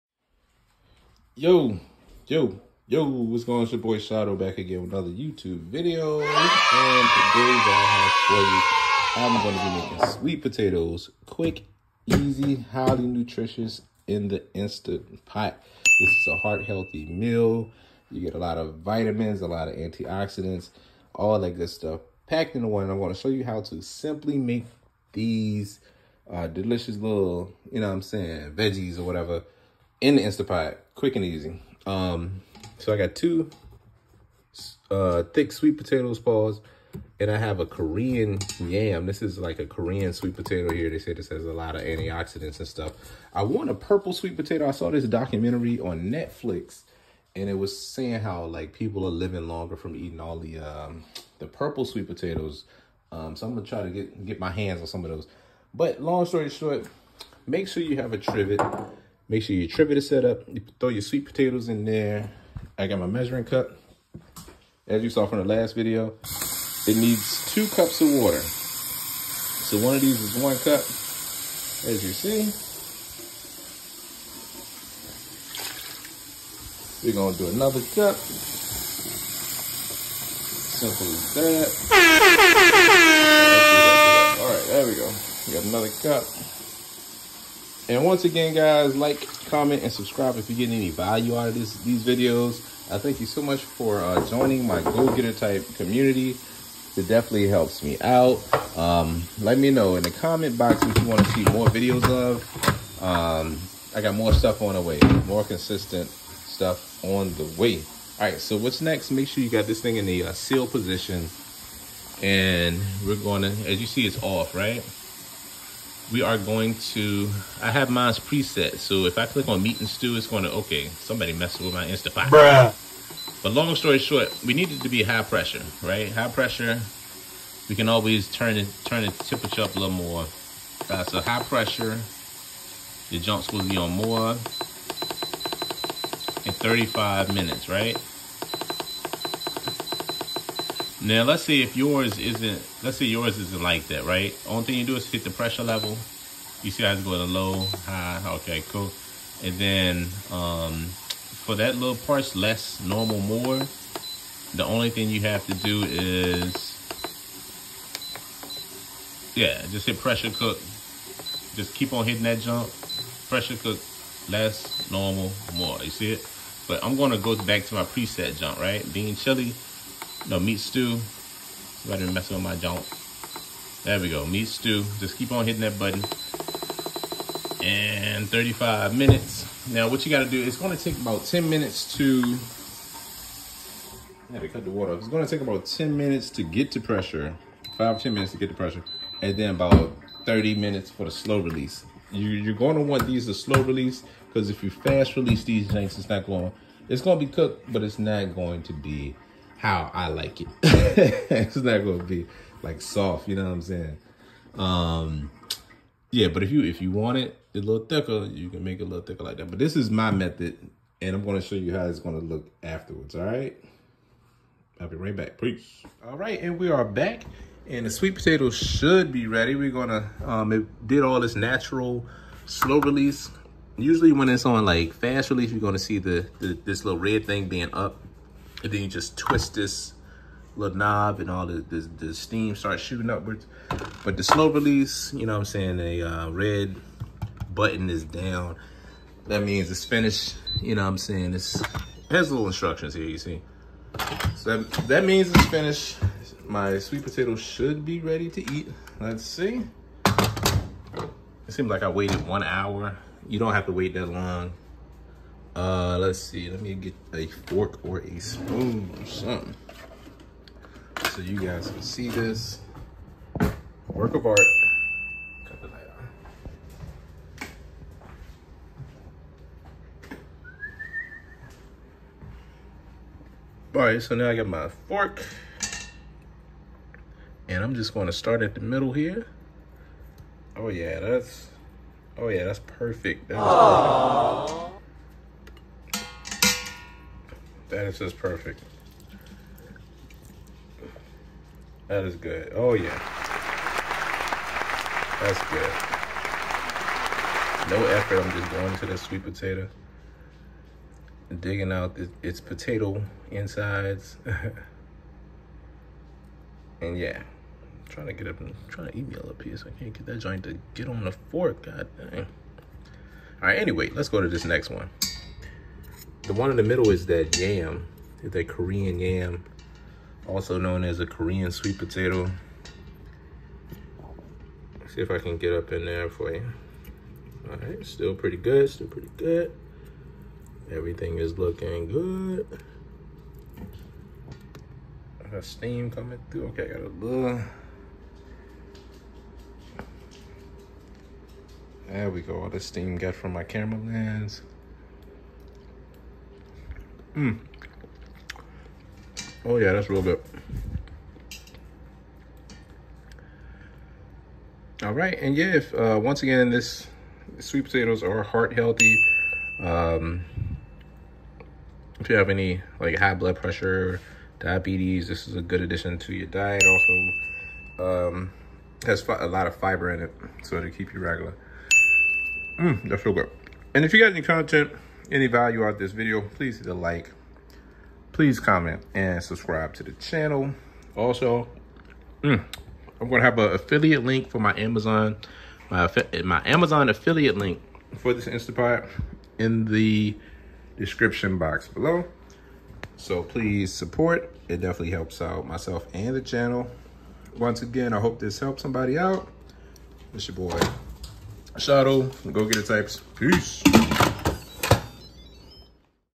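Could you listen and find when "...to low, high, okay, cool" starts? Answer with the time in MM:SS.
02:27.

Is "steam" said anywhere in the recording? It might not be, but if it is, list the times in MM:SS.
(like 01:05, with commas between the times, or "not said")
03:52, 05:35, 05:42.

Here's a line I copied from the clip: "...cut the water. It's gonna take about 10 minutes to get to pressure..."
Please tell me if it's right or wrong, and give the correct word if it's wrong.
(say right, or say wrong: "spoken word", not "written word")
right.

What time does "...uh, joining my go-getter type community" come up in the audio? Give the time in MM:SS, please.
01:33.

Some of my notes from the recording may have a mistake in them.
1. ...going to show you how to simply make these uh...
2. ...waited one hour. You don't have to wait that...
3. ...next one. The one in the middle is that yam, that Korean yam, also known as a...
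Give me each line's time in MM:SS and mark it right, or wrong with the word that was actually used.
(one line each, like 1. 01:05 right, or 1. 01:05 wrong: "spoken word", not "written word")
1. 00:22 right
2. 04:11 right
3. 05:14 right.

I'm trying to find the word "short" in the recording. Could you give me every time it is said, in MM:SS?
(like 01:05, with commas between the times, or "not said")
00:56, 02:03.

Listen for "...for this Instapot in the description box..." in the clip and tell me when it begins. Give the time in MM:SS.
06:27.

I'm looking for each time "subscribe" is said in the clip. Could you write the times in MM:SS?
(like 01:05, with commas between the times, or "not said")
01:29, 06:19.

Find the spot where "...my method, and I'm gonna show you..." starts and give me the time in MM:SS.
03:29.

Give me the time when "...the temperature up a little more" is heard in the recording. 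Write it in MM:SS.
02:09.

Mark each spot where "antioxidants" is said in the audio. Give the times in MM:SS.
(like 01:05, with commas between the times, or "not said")
00:19, 00:41.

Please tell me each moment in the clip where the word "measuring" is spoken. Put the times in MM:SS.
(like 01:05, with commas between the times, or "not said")
01:03.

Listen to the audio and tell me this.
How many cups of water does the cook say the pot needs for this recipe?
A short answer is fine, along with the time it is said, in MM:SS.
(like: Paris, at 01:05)
2 cups, at 01:07.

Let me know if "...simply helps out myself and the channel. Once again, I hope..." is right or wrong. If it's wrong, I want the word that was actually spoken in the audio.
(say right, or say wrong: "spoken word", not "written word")
wrong: "definitely", not "simply".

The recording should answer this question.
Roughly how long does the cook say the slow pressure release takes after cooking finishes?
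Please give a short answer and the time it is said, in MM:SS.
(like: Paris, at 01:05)
30 minutes, at 03:10.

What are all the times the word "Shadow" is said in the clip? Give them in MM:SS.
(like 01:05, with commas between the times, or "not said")
00:03, 06:41.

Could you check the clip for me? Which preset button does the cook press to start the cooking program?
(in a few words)
meat and stew.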